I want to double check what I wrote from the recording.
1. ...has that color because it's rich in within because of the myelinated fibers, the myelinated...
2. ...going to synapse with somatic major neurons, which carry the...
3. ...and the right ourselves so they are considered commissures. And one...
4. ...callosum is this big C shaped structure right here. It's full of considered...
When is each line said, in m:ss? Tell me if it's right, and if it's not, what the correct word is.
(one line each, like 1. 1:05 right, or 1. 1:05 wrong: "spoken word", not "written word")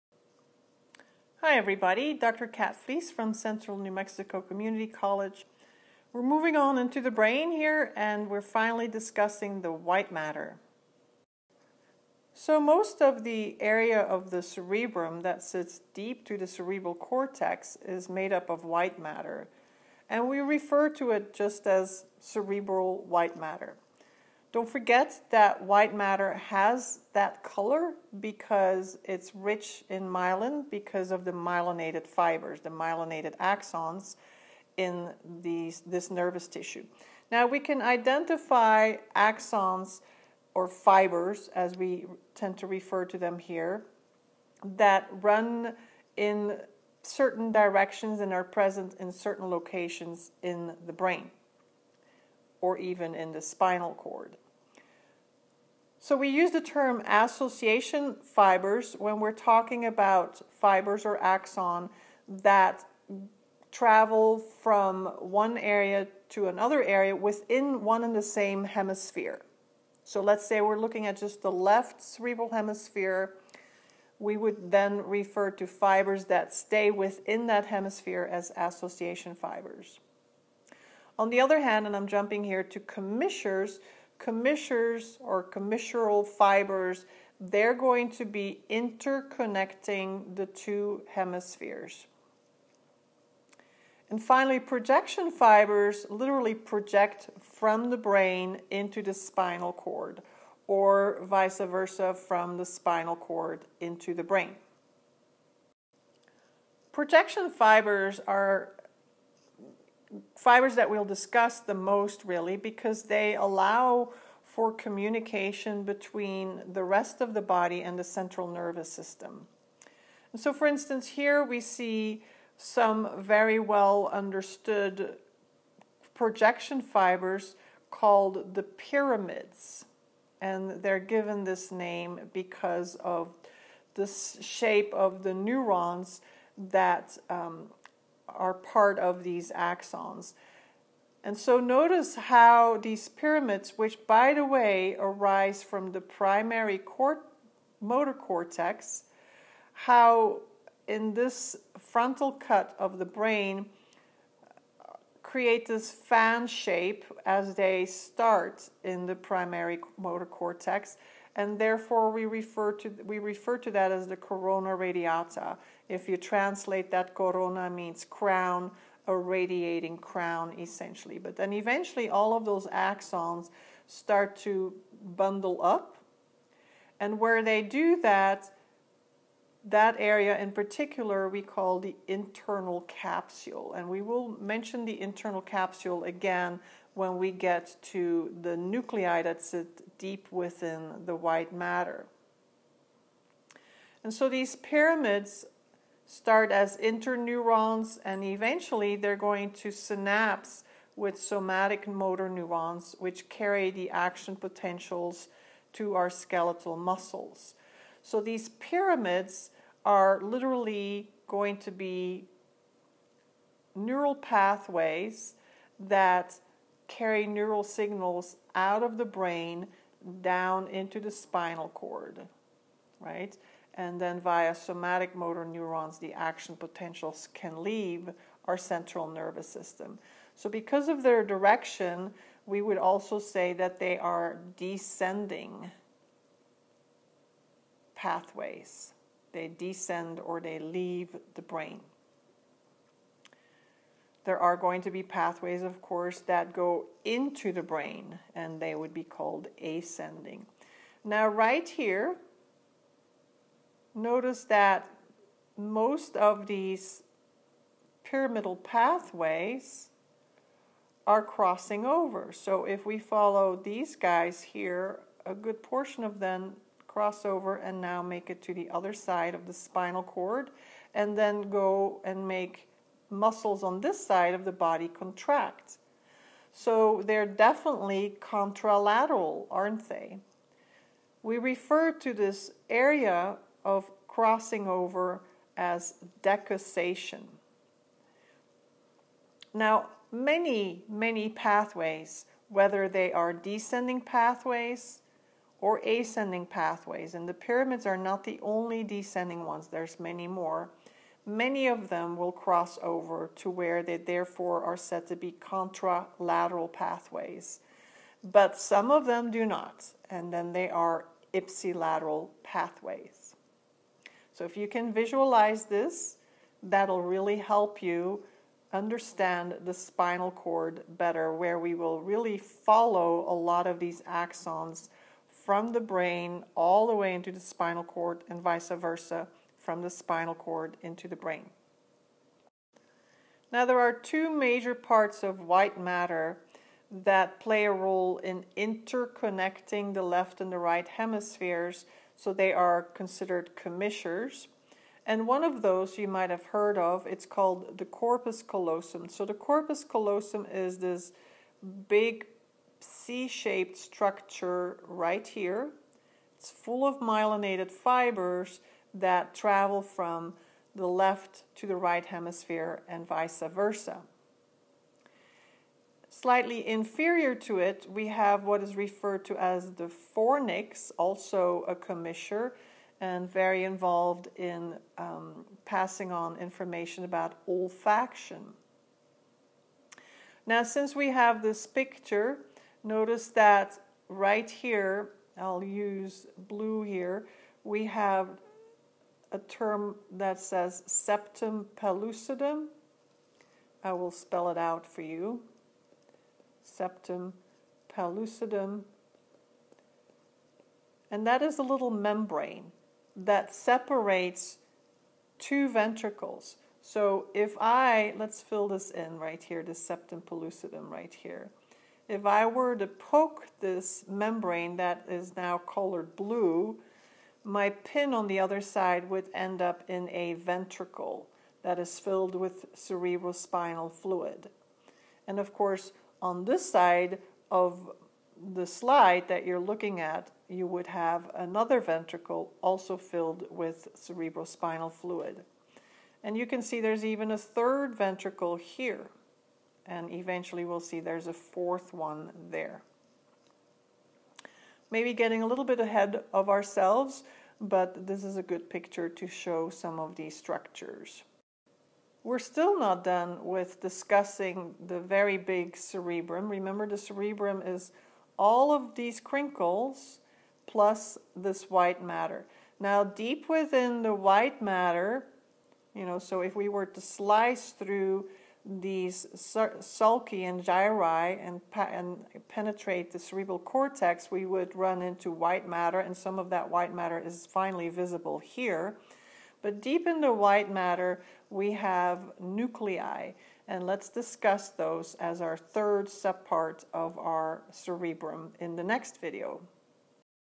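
1. 0:26 wrong: "myelin", not "within"
2. 3:19 wrong: "motor", not "major"
3. 5:40 wrong: "hemispheres", not "ourselves"
4. 5:49 wrong: "myelinated", not "considered".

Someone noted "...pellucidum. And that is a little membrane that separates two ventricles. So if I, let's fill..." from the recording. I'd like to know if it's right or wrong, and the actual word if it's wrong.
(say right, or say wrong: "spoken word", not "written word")
right.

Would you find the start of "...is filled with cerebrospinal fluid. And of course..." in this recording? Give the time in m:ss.
7:01.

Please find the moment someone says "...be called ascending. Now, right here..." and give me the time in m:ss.
4:08.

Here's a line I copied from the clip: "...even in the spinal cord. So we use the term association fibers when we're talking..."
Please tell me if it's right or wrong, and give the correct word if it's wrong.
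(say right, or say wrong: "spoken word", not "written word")
right.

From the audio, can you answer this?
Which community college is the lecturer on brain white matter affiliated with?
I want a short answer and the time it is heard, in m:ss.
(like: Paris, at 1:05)
Central New Mexico Community College, at 0:03.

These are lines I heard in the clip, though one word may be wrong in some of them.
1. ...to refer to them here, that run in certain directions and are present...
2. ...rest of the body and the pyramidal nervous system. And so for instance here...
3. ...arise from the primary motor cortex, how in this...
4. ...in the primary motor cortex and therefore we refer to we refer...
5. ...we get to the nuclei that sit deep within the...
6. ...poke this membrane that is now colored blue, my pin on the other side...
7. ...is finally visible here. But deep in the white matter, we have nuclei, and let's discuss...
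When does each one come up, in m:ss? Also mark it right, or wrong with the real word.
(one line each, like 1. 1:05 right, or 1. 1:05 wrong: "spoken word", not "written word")
1. 0:42 right
2. 1:56 wrong: "central", not "pyramidal"
3. 2:24 right
4. 2:38 right
5. 3:07 right
6. 6:52 right
7. 7:57 right.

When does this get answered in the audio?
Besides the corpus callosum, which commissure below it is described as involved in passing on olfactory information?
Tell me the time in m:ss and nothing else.
6:10.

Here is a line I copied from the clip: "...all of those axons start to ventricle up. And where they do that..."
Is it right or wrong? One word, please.
wrong.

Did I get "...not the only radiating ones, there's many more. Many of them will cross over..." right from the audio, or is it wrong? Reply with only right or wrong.
wrong.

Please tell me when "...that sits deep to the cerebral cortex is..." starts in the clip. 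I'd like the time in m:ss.
0:15.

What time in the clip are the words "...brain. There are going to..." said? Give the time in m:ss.
4:01.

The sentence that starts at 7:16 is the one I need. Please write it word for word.
And you can see there's even a third ventricle here.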